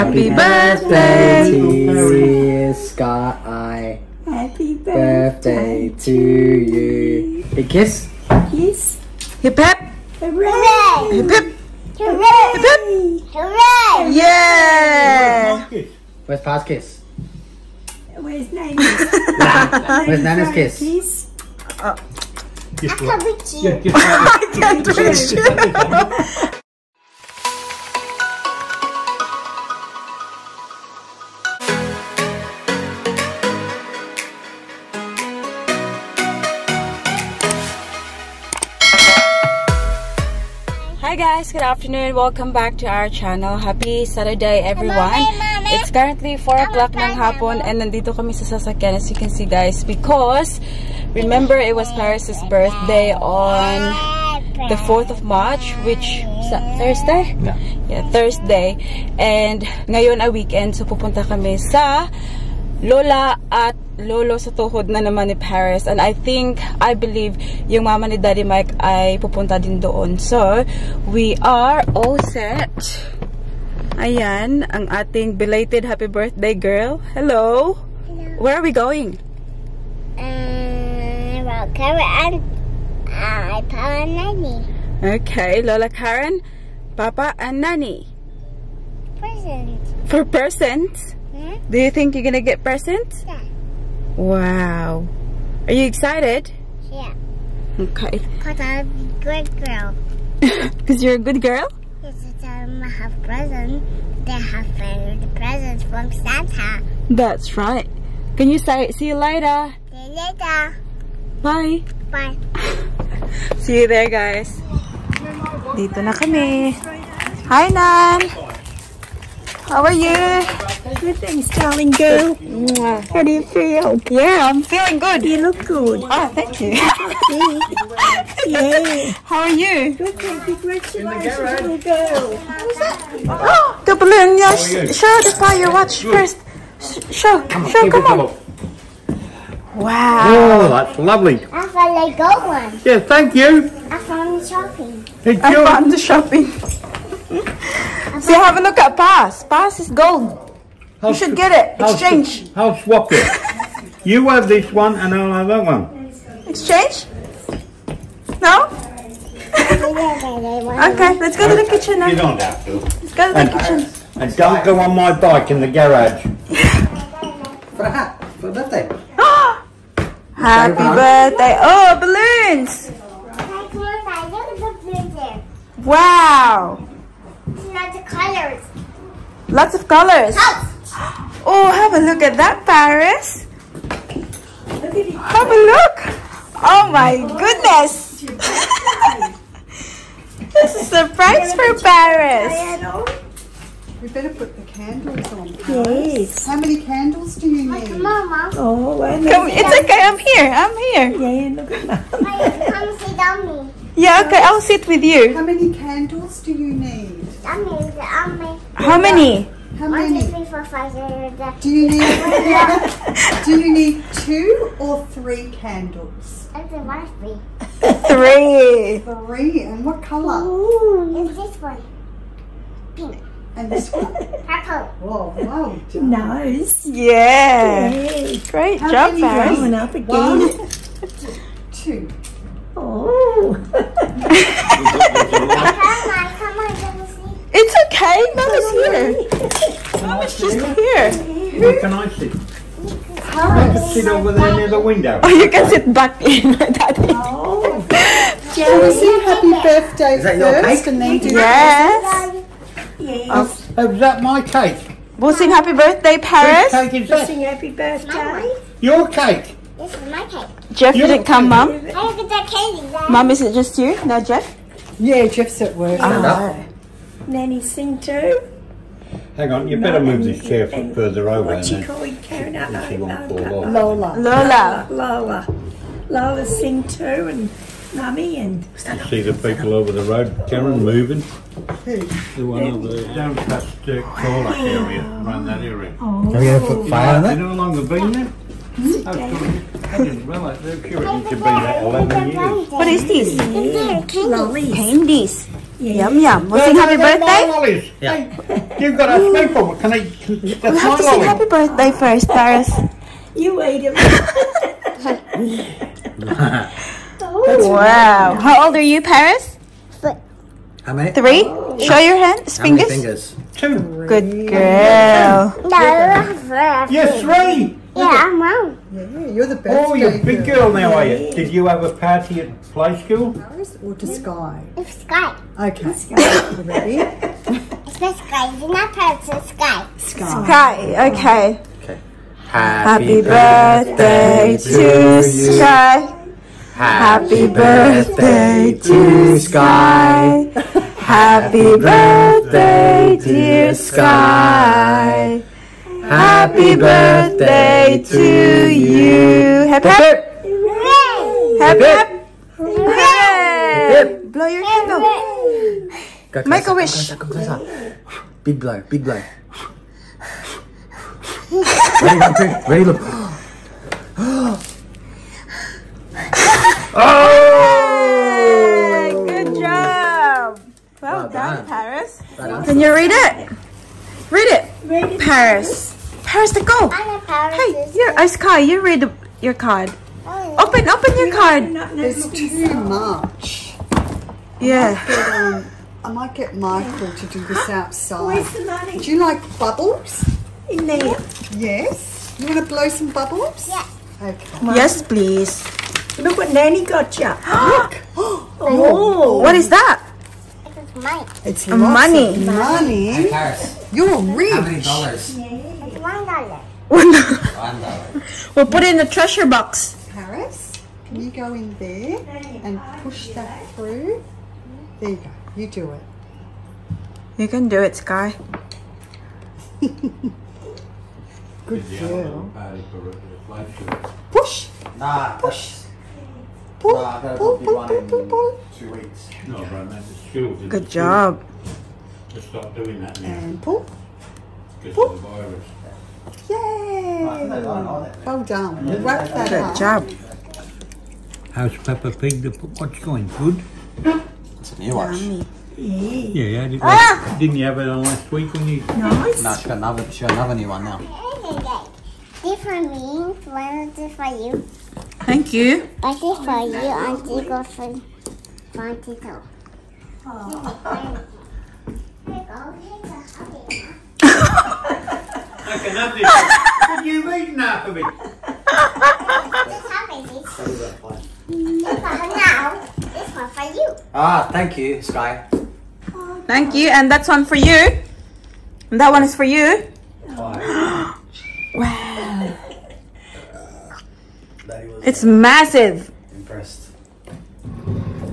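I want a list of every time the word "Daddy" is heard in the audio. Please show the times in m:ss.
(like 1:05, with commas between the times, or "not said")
1:08, 4:06.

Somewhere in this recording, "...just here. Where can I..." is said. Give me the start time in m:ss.
4:00.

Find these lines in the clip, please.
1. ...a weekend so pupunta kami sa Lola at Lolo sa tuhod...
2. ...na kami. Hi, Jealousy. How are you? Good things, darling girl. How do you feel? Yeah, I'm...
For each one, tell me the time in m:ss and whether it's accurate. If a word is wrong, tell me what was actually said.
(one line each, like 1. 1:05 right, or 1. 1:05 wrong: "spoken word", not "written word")
1. 1:00 right
2. 1:56 wrong: "Nan", not "Jealousy".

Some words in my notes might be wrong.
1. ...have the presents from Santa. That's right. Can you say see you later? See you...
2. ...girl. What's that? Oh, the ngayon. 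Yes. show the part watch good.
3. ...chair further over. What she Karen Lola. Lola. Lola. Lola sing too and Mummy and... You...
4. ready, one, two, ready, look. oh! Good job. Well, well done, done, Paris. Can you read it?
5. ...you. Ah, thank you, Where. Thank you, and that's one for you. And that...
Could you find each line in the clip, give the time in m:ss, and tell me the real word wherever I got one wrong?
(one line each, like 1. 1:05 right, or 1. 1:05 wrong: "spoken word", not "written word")
1. 1:44 right
2. 2:11 wrong: "balloon", not "ngayon"
3. 4:30 right
4. 6:01 right
5. 7:53 wrong: "Sky", not "Where".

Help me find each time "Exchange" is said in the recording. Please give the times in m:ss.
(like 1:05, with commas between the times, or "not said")
2:31, 2:36.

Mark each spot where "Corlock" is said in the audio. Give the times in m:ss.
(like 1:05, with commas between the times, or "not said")
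4:44.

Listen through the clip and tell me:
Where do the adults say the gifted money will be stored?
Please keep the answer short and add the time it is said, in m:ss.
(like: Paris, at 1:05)
Treasure box, at 6:49.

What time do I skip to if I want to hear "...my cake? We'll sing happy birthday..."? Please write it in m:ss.
4:14.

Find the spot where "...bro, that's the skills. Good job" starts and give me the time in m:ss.
7:09.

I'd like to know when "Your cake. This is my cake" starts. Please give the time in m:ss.
4:18.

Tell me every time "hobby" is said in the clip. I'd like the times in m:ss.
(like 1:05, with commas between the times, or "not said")
7:43.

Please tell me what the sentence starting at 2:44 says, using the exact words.
Uh, and don't go on my bike in the garage.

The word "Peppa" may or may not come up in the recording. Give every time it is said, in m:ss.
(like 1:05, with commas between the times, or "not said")
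7:21.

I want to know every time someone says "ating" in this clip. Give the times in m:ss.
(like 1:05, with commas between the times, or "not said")
1:14.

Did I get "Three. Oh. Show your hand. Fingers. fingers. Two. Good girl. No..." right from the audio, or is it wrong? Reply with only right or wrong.
right.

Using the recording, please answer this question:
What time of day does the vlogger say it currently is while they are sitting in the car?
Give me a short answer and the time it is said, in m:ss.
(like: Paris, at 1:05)
4 o'clock, at 0:46.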